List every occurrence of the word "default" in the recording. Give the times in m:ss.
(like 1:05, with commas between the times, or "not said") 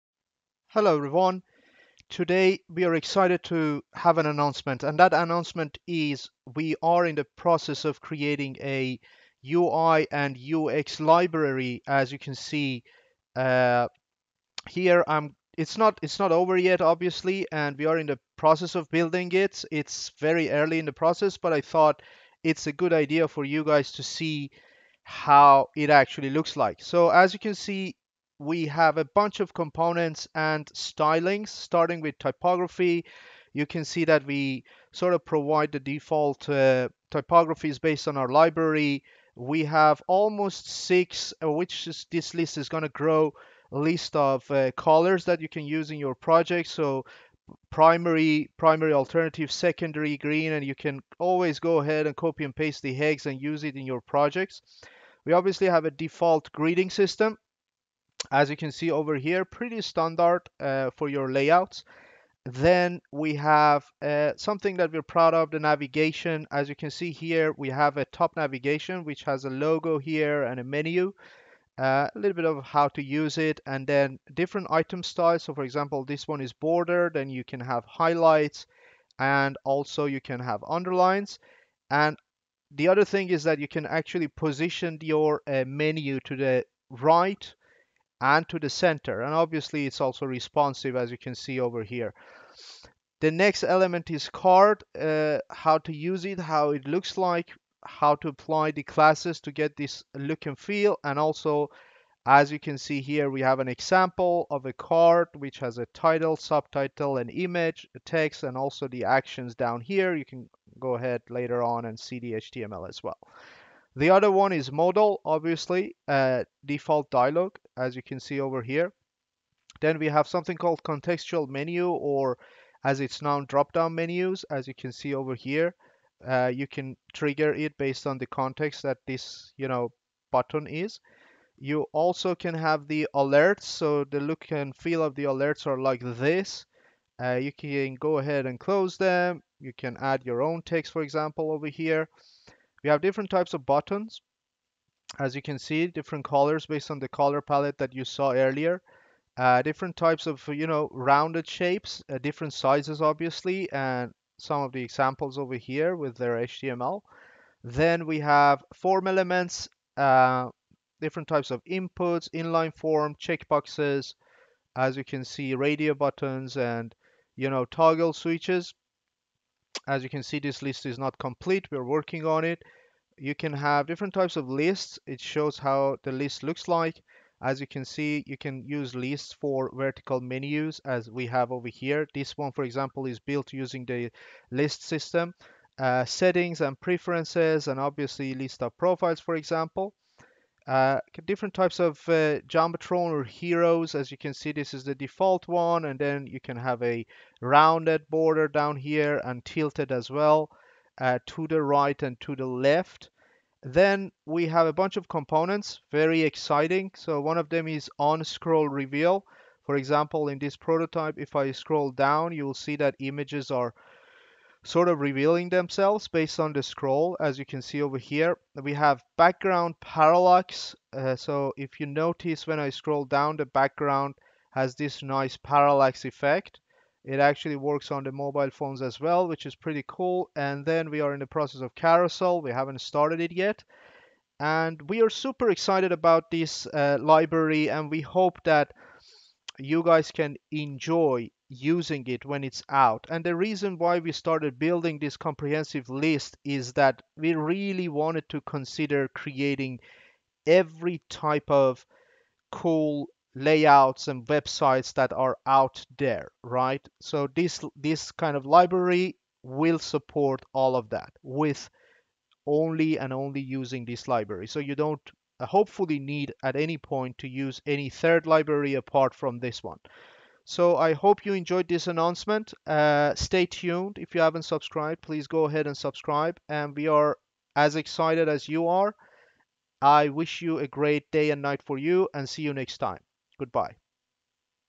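0:35, 0:55, 1:56, 3:14.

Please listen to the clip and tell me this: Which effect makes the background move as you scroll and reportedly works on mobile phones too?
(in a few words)
background parallax.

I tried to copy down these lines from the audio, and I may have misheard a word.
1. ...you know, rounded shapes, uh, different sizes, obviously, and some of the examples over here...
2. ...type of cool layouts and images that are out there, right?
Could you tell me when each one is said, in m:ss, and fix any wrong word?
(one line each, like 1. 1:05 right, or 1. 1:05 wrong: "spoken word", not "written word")
1. 2:30 right
2. 4:11 wrong: "websites", not "images".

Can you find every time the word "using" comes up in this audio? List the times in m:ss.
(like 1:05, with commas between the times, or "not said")
3:03, 4:01, 4:23.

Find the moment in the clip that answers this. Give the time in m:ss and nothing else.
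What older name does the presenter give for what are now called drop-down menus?
2:00.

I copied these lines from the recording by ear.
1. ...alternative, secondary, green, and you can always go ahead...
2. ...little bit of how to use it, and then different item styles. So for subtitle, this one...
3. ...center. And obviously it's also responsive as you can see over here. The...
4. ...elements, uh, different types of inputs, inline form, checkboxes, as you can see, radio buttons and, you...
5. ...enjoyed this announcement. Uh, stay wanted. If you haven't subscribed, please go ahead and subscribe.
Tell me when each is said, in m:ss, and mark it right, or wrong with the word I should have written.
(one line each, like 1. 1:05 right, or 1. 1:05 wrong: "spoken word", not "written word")
1. 0:48 right
2. 1:12 wrong: "example", not "subtitle"
3. 1:28 right
4. 2:39 right
5. 4:31 wrong: "tuned", not "wanted".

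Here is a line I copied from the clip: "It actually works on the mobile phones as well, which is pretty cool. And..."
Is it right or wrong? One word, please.
right.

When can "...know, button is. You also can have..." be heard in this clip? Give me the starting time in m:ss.
2:09.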